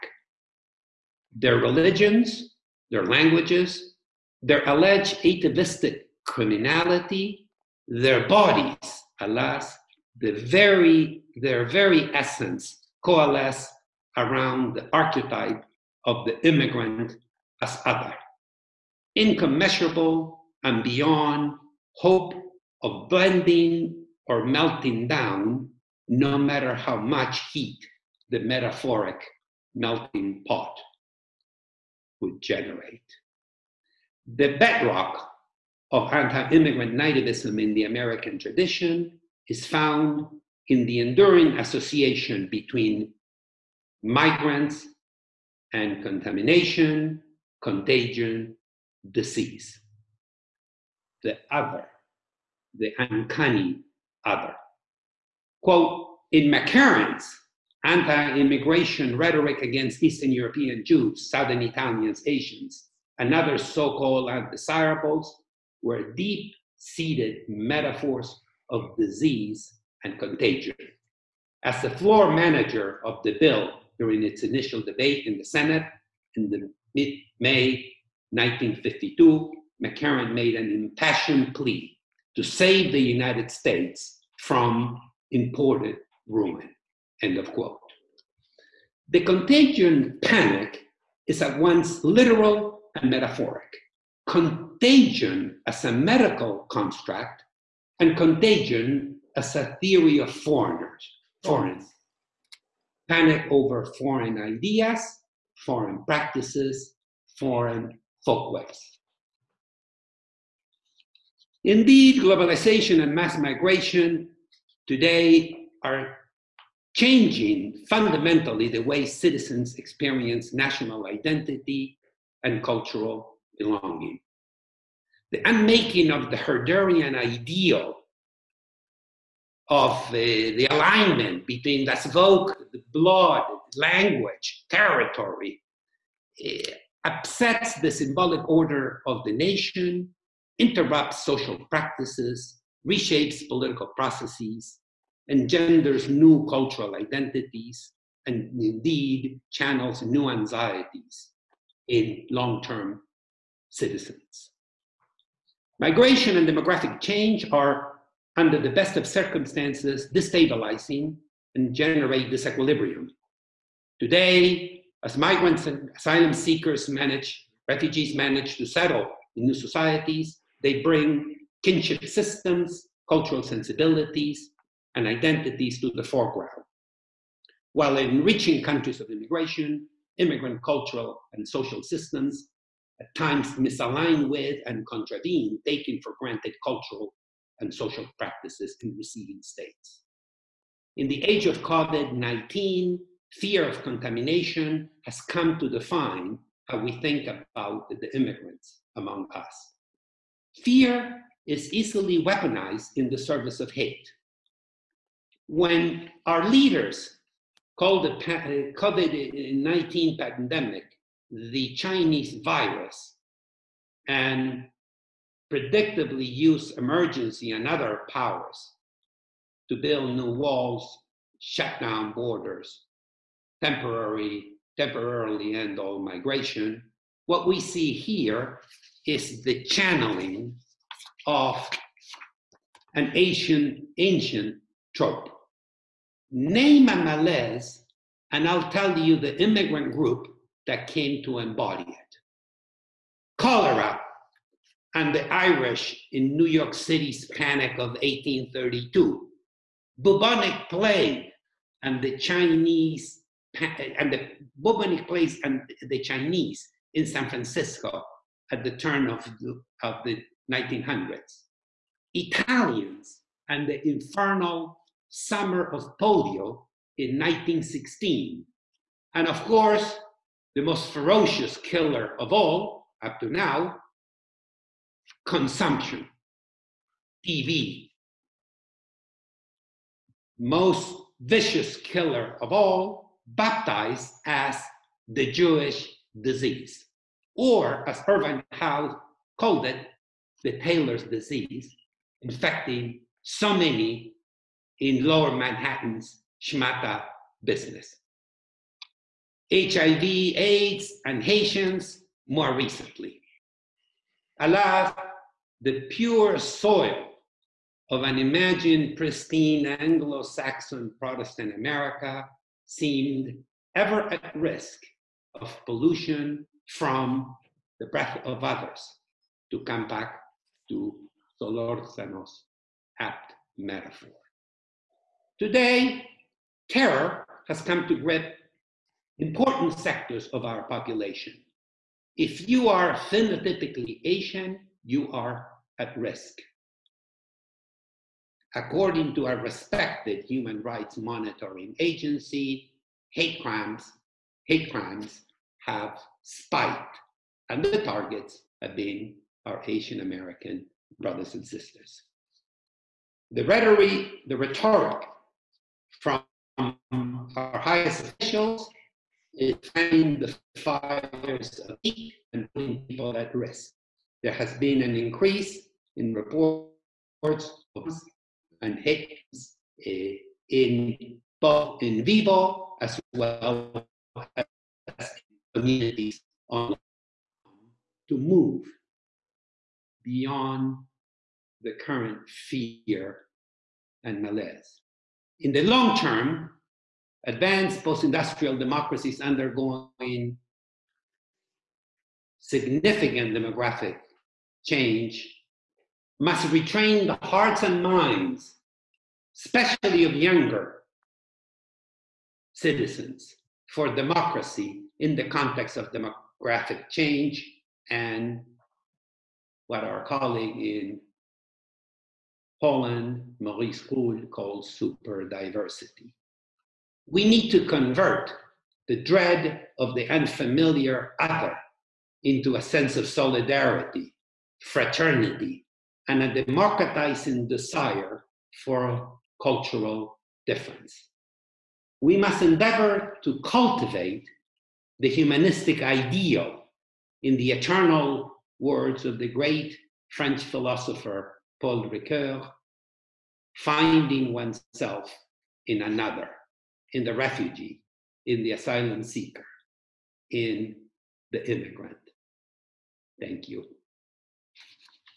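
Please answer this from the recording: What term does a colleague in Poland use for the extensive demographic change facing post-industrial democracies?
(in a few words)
Super diversity.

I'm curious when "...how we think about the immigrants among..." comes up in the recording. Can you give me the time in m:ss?
3:16.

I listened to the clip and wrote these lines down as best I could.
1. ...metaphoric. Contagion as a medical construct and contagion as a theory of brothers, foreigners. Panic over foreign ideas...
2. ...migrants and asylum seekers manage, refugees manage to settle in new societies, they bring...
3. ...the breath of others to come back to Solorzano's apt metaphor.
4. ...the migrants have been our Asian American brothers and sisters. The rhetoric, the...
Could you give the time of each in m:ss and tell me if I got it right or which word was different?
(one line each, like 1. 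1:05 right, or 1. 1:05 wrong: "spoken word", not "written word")
1. 1:33 wrong: "foreigners", not "brothers"
2. 2:45 right
3. 5:17 right
4. 5:47 wrong: "targets", not "migrants".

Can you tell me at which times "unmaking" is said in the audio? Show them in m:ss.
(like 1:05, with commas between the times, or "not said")
2:05.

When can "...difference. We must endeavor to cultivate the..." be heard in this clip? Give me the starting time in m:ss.
7:10.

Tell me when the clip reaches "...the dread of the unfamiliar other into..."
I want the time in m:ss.
6:58.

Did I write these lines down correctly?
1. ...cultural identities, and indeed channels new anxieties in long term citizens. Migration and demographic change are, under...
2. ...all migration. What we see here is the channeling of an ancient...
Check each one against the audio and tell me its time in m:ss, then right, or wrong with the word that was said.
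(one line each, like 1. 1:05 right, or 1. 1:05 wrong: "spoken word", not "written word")
1. 2:26 right
2. 3:45 right.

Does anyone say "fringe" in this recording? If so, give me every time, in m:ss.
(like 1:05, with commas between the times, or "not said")
not said.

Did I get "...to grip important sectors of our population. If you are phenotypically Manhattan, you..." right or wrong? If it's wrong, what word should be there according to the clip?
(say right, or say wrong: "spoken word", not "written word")
wrong: "Asian", not "Manhattan".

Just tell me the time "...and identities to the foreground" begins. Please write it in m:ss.
2:54.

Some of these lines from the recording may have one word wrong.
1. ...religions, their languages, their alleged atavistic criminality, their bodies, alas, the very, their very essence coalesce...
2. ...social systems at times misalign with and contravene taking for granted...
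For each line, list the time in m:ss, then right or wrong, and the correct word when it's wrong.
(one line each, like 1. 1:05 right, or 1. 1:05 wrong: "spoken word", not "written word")
1. 0:01 right
2. 3:01 right.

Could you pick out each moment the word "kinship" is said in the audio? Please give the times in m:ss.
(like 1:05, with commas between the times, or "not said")
2:51.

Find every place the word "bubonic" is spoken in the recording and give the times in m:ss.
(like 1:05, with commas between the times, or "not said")
4:10, 4:14.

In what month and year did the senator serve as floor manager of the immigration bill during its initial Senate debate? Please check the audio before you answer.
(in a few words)
May 1952.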